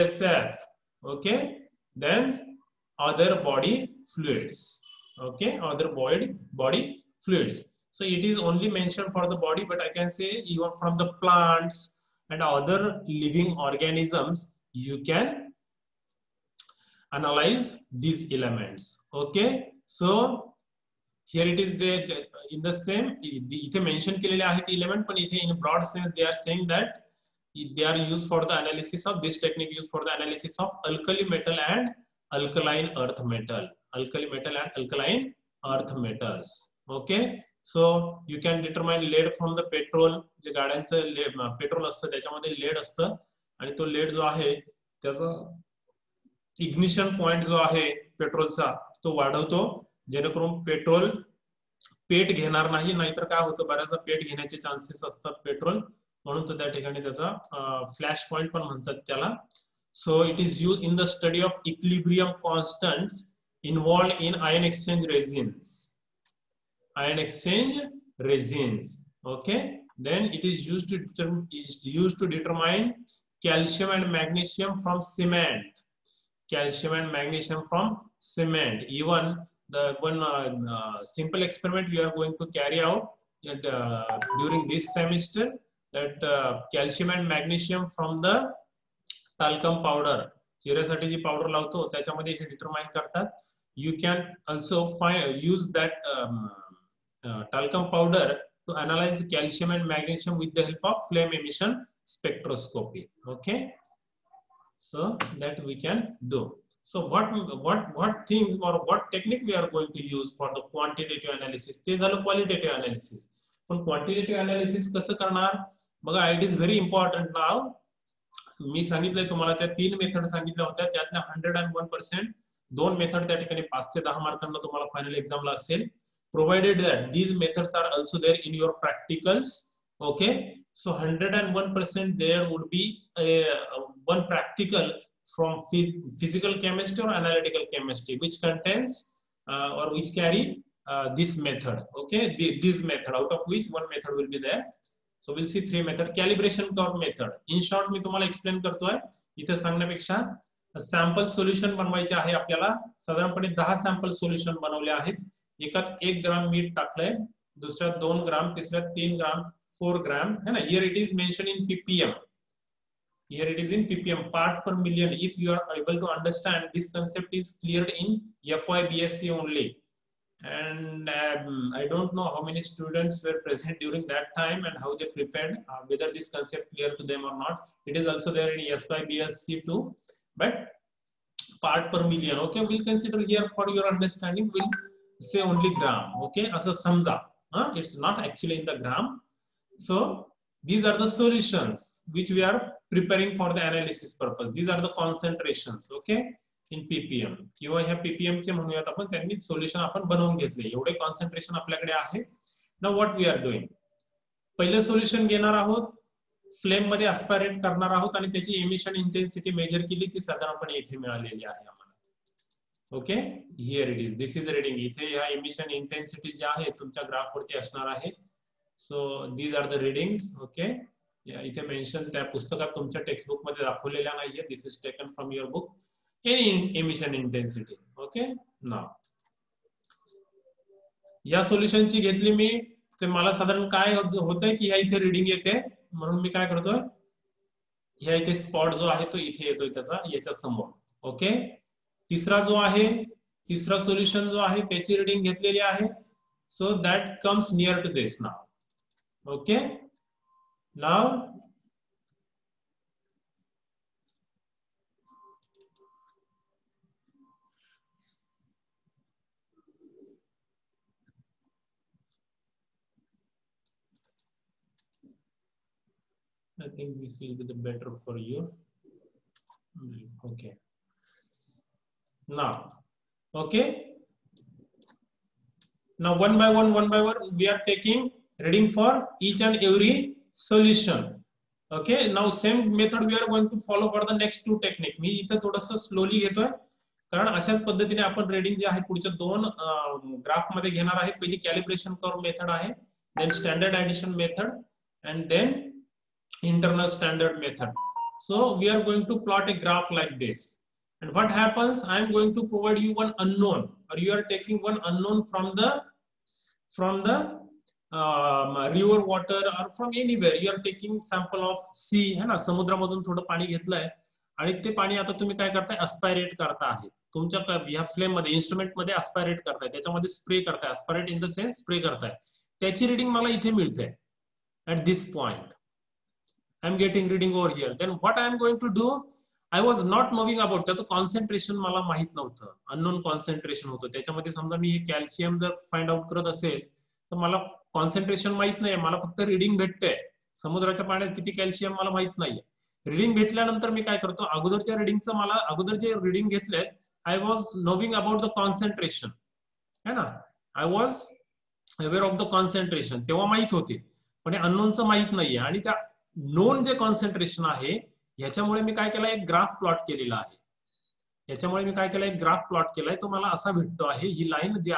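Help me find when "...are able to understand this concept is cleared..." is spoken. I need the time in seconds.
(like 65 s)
165 s.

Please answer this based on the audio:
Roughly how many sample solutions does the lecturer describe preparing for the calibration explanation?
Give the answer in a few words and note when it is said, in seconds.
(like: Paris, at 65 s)
10, at 153 s.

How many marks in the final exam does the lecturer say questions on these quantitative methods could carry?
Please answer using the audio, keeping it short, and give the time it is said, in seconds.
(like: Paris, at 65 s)
5 to 10, at 123 s.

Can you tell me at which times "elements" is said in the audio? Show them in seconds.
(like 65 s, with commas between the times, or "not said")
18 s, 24 s.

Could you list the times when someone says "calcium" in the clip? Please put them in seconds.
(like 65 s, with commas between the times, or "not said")
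76 s, 86 s, 99 s.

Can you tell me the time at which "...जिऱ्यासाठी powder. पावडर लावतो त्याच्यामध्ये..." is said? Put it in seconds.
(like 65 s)
90 s.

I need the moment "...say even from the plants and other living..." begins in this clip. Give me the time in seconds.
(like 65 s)
10 s.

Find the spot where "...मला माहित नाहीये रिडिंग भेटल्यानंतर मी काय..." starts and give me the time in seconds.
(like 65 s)
341 s.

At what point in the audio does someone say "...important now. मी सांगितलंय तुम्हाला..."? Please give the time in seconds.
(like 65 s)
116 s.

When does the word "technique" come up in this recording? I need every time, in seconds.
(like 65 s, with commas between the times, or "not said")
29 s, 109 s.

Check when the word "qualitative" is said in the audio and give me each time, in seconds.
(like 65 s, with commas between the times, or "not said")
112 s.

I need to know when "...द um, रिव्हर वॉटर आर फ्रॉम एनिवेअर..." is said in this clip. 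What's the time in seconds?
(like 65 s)
307 s.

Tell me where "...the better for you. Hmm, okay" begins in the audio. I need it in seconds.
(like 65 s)
267 s.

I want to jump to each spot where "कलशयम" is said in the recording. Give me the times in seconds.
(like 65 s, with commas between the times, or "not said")
73 s, 334 s, 341 s.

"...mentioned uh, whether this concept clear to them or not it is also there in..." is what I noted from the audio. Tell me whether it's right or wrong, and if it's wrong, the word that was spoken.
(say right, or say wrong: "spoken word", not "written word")
wrong: "prepared", not "mentioned".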